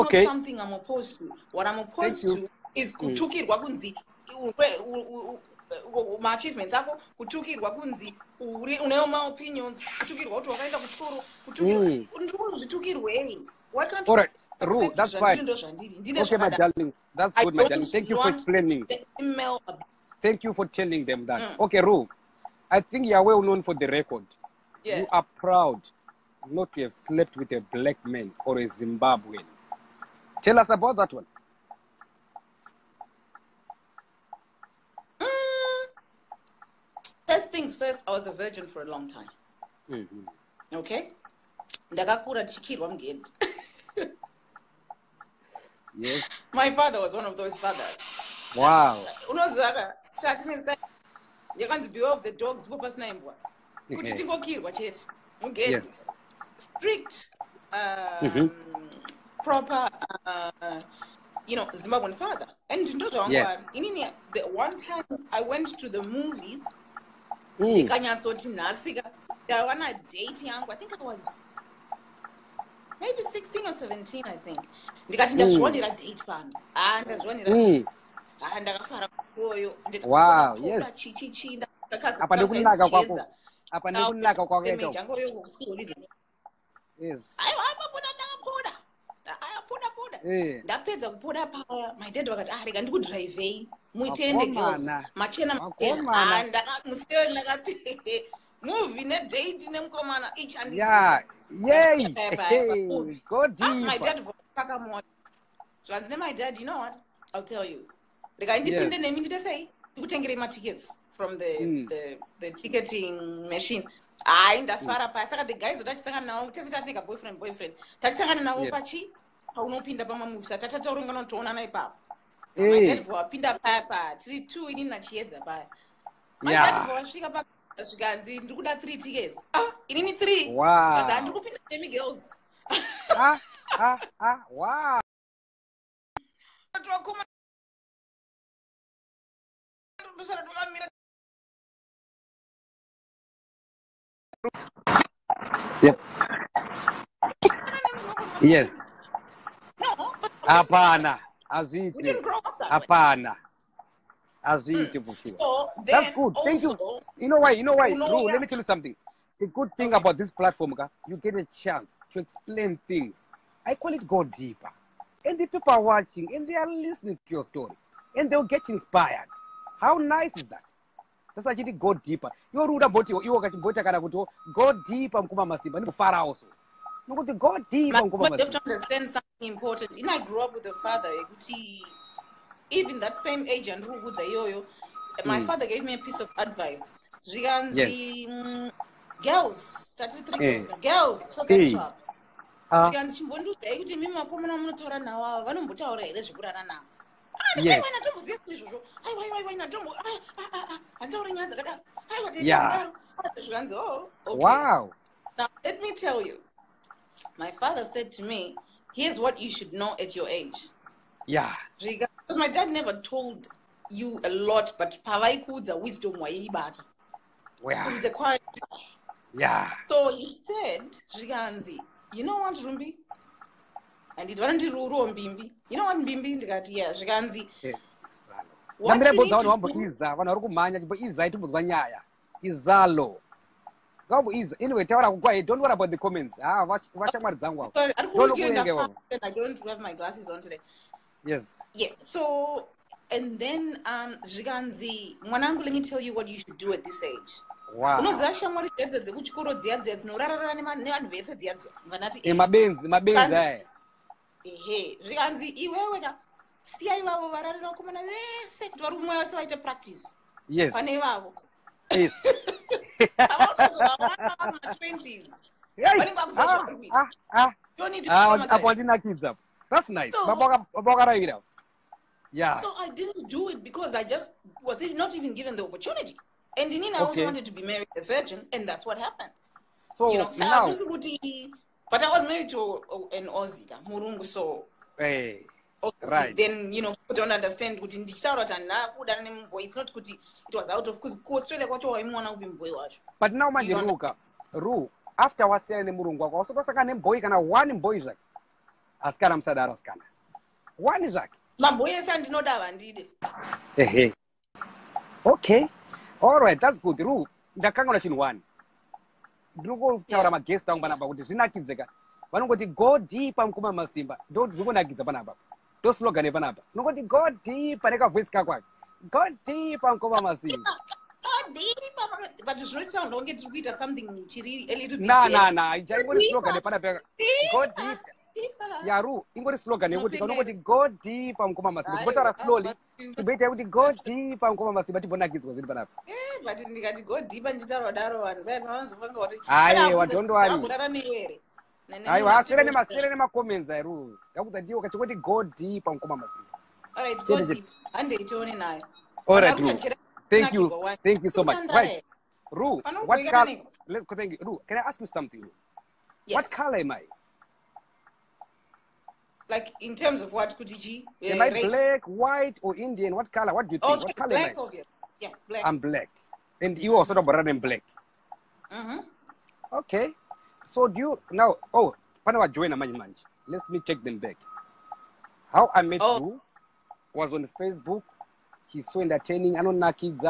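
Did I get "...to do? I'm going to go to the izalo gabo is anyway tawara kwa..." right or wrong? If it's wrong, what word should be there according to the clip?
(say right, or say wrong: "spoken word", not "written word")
right.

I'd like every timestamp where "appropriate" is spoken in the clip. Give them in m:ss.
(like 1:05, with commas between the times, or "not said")
not said.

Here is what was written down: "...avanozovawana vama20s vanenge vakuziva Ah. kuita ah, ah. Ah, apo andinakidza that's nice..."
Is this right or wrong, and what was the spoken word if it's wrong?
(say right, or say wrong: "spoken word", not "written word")
right.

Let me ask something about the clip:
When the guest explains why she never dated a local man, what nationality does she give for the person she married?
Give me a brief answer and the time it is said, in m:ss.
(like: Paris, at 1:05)
Aussie, at 4:43.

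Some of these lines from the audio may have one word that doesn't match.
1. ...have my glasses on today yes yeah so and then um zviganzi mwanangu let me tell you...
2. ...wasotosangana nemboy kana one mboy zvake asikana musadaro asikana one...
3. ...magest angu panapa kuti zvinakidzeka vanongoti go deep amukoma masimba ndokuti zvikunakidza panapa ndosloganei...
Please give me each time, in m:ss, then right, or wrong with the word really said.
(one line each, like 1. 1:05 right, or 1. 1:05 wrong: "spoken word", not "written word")
1. 3:59 right
2. 4:56 right
3. 5:10 right.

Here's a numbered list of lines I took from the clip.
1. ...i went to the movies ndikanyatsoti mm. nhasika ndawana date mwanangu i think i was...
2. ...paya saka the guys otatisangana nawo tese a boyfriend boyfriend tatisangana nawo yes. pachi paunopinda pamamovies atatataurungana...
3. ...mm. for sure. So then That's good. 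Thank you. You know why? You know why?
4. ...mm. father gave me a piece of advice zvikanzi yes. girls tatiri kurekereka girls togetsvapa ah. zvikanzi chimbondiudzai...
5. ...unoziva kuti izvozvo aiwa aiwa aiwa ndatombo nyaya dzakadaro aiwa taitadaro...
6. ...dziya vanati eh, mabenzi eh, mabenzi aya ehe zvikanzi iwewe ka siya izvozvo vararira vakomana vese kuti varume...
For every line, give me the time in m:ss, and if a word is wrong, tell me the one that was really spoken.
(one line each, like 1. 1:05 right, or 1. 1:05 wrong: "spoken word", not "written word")
1. 1:05 wrong: "yangu", not "mwanangu"
2. 1:55 right
3. 2:34 right
4. 3:05 right
5. 3:17 wrong: "ndatomboziva", not "unoziva"
6. 4:11 wrong: "ivavo", not "izvozvo".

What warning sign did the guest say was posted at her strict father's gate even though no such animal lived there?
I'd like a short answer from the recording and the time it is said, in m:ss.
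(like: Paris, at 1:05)
Beware of the dogs, at 0:51.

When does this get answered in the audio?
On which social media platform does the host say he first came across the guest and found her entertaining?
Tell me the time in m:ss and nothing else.
6:17.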